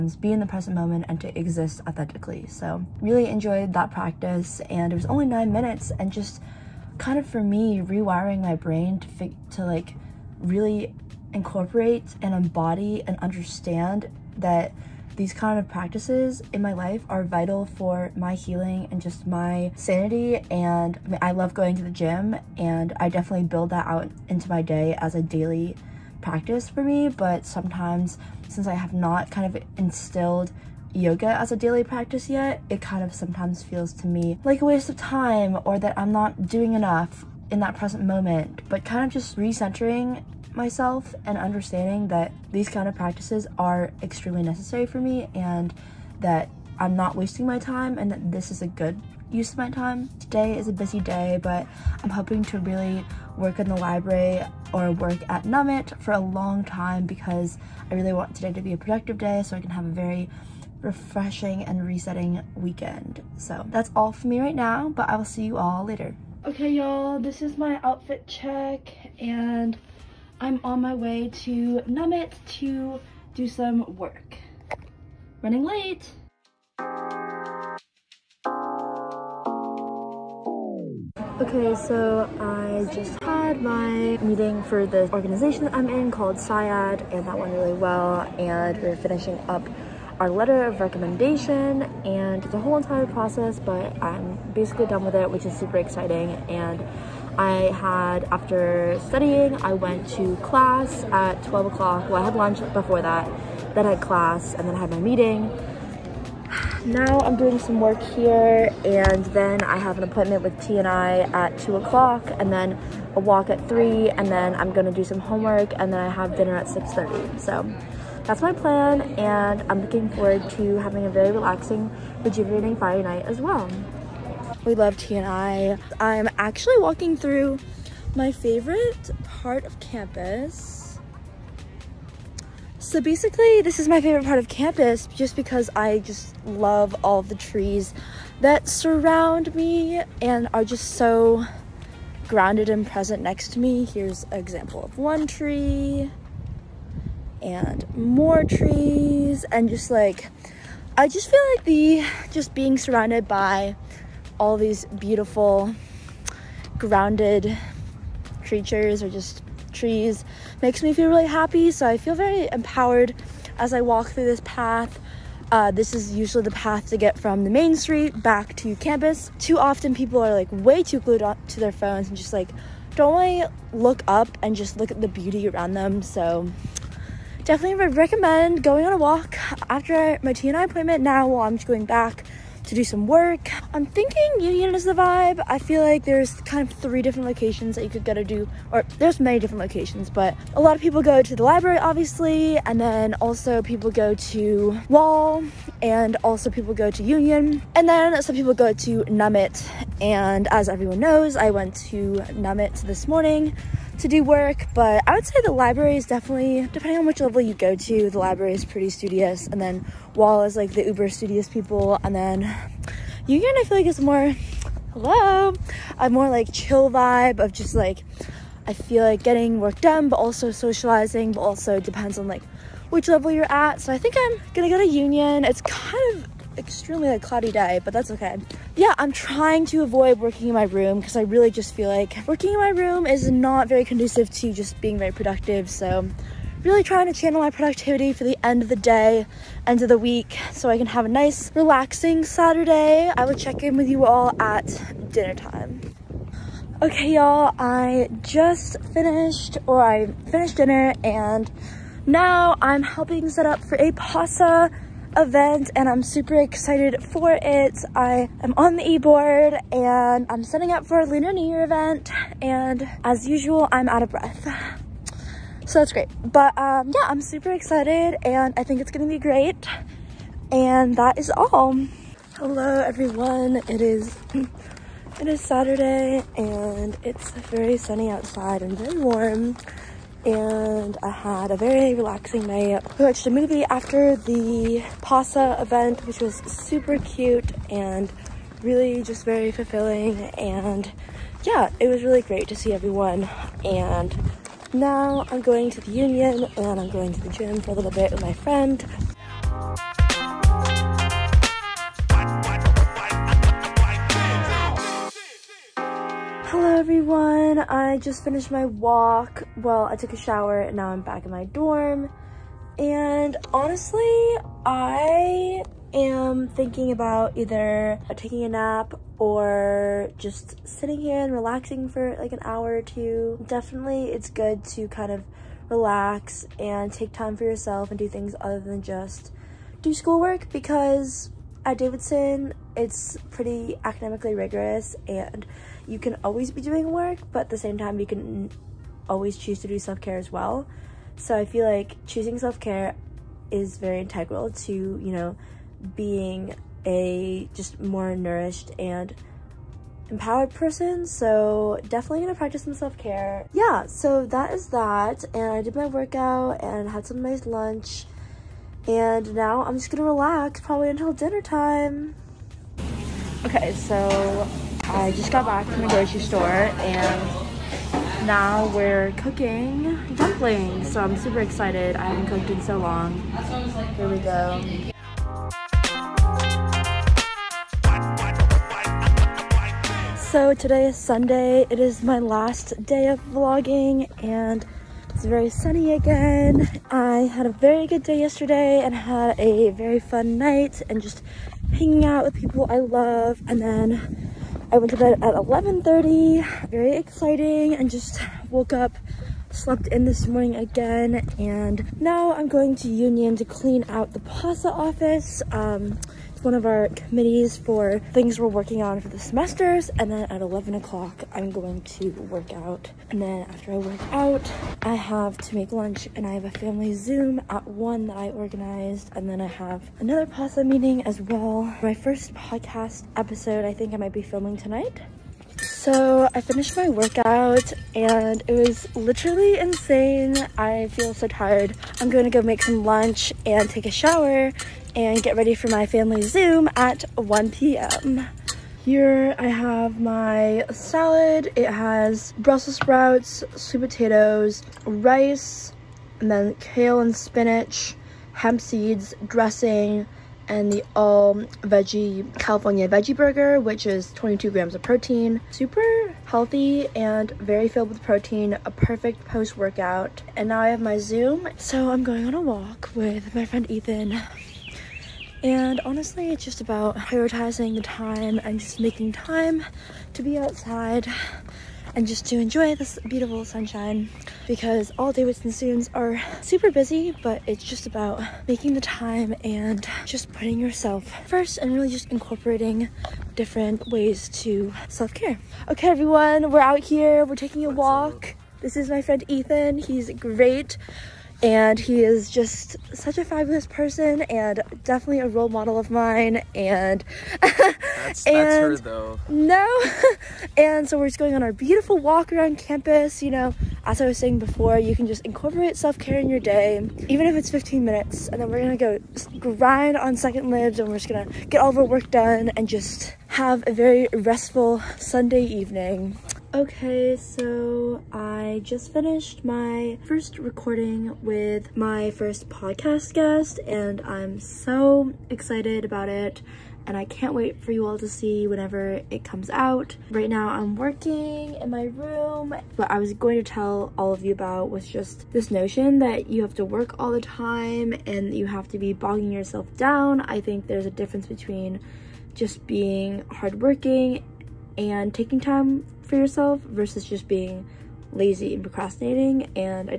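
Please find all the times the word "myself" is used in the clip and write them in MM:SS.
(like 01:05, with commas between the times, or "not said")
00:40.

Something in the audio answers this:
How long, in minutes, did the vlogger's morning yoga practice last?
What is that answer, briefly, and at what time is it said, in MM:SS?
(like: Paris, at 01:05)
9, at 00:05.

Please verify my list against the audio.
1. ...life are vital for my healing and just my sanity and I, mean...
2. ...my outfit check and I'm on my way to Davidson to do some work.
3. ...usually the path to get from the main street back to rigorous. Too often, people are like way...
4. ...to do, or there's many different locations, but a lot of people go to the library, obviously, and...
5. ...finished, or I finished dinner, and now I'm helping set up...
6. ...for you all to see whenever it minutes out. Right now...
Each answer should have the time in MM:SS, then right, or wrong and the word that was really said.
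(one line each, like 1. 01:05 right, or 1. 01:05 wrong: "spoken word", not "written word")
1. 00:16 right
2. 01:07 wrong: "Nummit", not "Davidson"
3. 02:46 wrong: "campus", not "rigorous"
4. 03:08 right
5. 04:08 right
6. 08:47 wrong: "comes", not "minutes".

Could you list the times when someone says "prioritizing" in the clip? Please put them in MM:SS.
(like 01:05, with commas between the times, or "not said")
07:46.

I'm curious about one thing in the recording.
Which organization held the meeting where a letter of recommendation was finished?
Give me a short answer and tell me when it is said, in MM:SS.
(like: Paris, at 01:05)
SIAD, at 01:26.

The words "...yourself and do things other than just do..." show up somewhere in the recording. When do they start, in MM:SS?
05:27.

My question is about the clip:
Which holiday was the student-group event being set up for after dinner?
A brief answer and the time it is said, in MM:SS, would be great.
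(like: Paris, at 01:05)
Lunar New Year, at 04:21.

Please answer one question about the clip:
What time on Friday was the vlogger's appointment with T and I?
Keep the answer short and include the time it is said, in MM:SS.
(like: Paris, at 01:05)
2:00, at 01:51.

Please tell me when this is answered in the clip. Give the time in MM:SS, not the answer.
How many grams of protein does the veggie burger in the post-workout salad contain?
07:34.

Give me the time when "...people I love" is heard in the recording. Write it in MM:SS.
06:32.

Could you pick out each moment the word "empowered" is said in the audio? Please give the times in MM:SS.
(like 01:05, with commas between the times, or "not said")
02:42, 05:50.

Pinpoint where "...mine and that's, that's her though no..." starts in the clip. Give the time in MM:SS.
08:15.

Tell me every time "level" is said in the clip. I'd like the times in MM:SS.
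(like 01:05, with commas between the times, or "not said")
03:27, 03:43.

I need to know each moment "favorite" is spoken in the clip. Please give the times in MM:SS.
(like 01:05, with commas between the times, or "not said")
02:08, 02:14.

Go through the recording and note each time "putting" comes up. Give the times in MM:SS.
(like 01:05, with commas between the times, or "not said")
08:00.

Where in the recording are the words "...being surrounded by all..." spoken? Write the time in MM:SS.
02:32.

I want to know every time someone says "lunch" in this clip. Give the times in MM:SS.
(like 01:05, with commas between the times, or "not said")
01:42, 05:57, 06:55, 07:12.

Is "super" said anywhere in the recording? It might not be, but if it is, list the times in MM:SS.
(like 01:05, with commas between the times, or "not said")
01:35, 04:16, 04:27, 04:46, 06:11, 07:35, 07:56.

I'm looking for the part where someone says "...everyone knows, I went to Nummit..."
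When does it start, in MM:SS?
03:20.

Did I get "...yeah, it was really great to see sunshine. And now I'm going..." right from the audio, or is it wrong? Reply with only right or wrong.
wrong.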